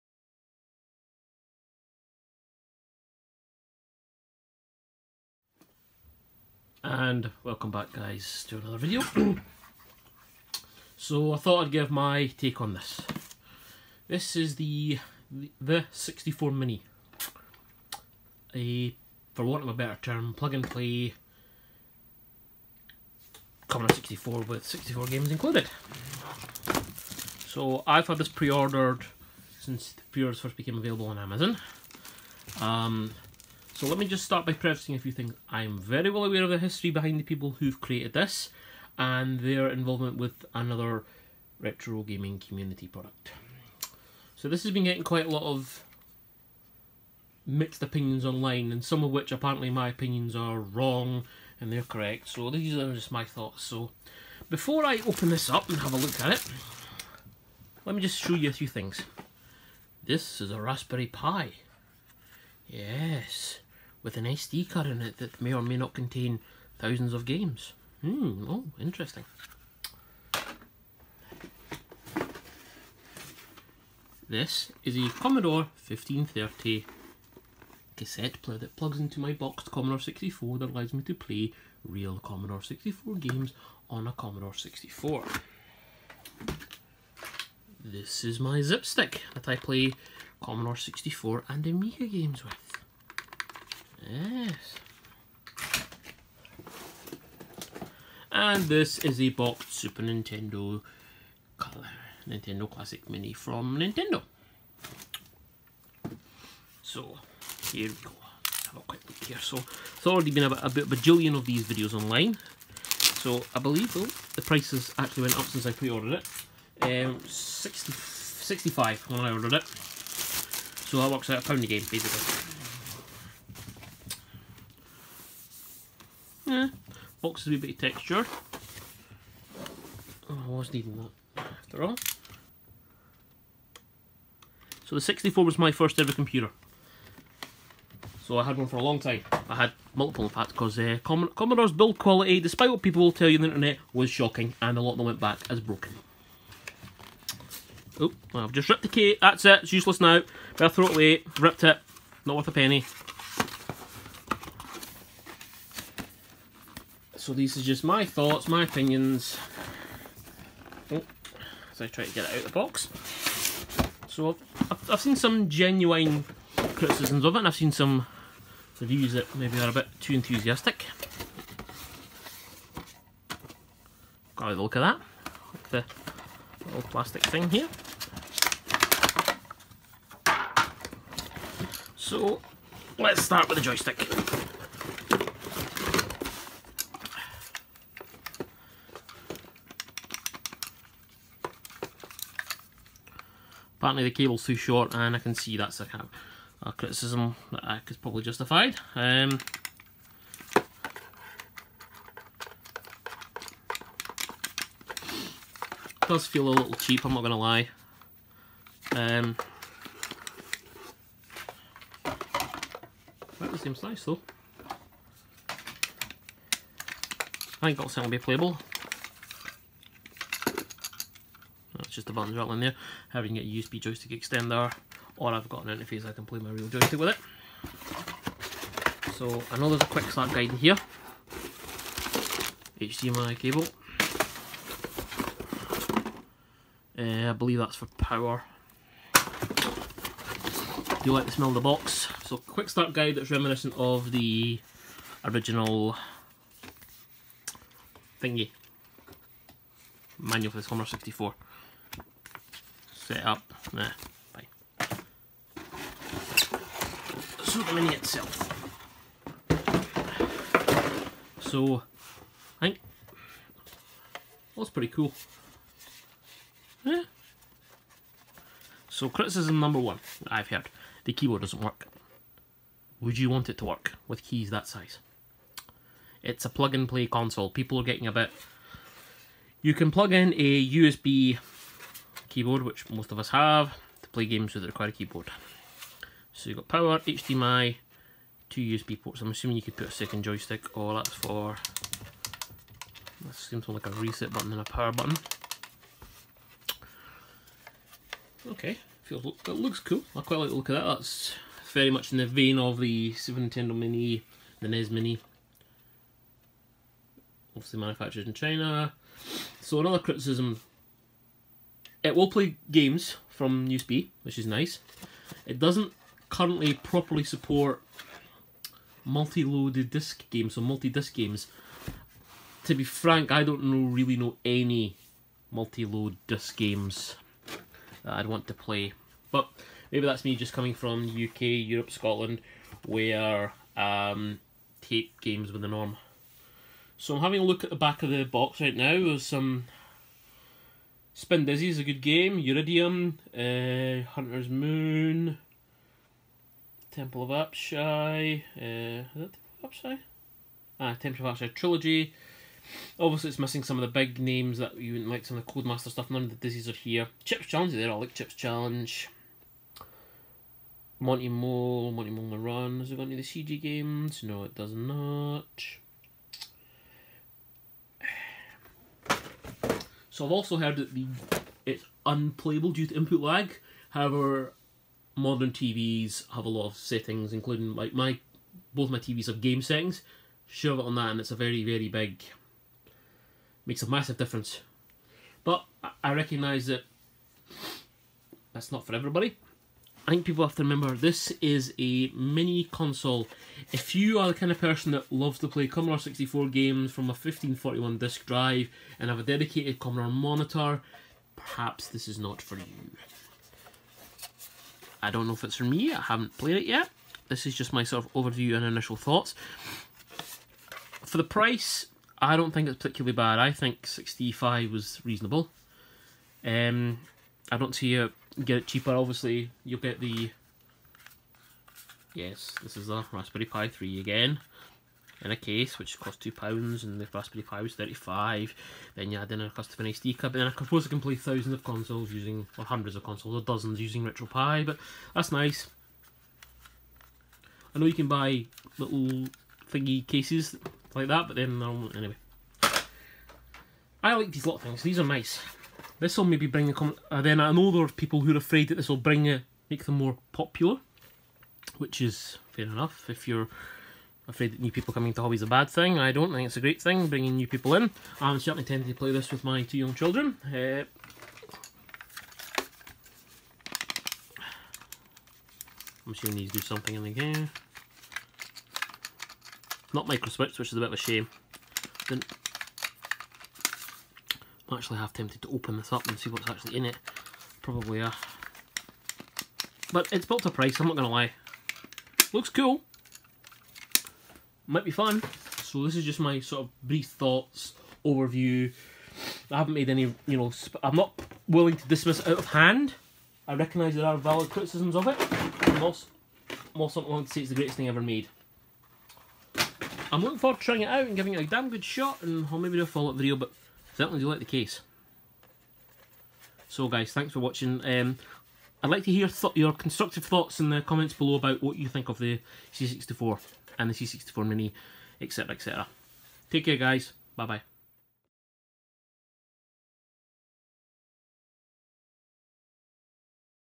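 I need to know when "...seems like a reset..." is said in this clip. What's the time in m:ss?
4:53.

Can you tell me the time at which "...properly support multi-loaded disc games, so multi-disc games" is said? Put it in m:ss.
5:16.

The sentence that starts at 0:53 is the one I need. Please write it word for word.
So before I open this up and have a look at it, let me just show you a few things.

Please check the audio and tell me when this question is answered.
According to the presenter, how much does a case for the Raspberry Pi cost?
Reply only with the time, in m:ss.
7:06.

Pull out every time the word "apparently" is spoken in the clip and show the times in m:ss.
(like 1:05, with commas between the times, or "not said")
0:49, 3:13.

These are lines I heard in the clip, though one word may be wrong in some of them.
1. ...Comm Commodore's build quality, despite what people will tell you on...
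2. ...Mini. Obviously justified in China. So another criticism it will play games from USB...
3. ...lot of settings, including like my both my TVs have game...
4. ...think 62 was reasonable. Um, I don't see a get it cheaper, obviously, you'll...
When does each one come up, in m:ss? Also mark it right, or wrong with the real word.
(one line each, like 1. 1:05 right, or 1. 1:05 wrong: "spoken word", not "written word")
1. 2:20 right
2. 5:04 wrong: "manufactured", not "justified"
3. 6:16 right
4. 6:53 wrong: "65", not "62".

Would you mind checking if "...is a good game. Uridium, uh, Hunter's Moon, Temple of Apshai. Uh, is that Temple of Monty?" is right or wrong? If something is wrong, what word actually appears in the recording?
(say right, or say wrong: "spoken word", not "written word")
wrong: "Apshai", not "Monty".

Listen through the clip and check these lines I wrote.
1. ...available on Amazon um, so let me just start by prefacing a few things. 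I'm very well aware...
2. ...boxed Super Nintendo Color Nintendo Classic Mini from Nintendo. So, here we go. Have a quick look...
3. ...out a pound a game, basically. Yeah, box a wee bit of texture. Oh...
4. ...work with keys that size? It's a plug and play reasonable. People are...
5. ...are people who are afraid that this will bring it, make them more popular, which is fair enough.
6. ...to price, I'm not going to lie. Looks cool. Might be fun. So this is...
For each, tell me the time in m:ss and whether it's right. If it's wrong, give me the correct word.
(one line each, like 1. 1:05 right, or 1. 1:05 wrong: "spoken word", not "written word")
1. 0:30 right
2. 1:39 right
3. 2:01 right
4. 4:33 wrong: "console", not "reasonable"
5. 7:27 right
6. 8:00 right.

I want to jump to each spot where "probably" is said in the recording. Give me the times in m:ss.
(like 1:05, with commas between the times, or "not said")
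3:17, 7:57.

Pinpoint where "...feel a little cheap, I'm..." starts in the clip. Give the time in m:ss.
3:26.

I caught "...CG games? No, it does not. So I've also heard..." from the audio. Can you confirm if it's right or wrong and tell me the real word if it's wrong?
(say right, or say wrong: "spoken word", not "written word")
right.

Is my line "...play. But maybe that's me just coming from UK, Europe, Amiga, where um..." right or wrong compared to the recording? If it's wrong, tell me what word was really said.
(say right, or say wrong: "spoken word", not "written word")
wrong: "Scotland", not "Amiga".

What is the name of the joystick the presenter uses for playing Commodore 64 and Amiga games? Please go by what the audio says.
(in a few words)
Zipstick.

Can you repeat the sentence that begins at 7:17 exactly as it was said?
I know you can buy little thingy cases like that, but then, um, anyway.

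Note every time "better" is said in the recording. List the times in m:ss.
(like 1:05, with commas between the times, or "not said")
0:19, 2:30.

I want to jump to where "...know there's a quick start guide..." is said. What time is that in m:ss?
3:49.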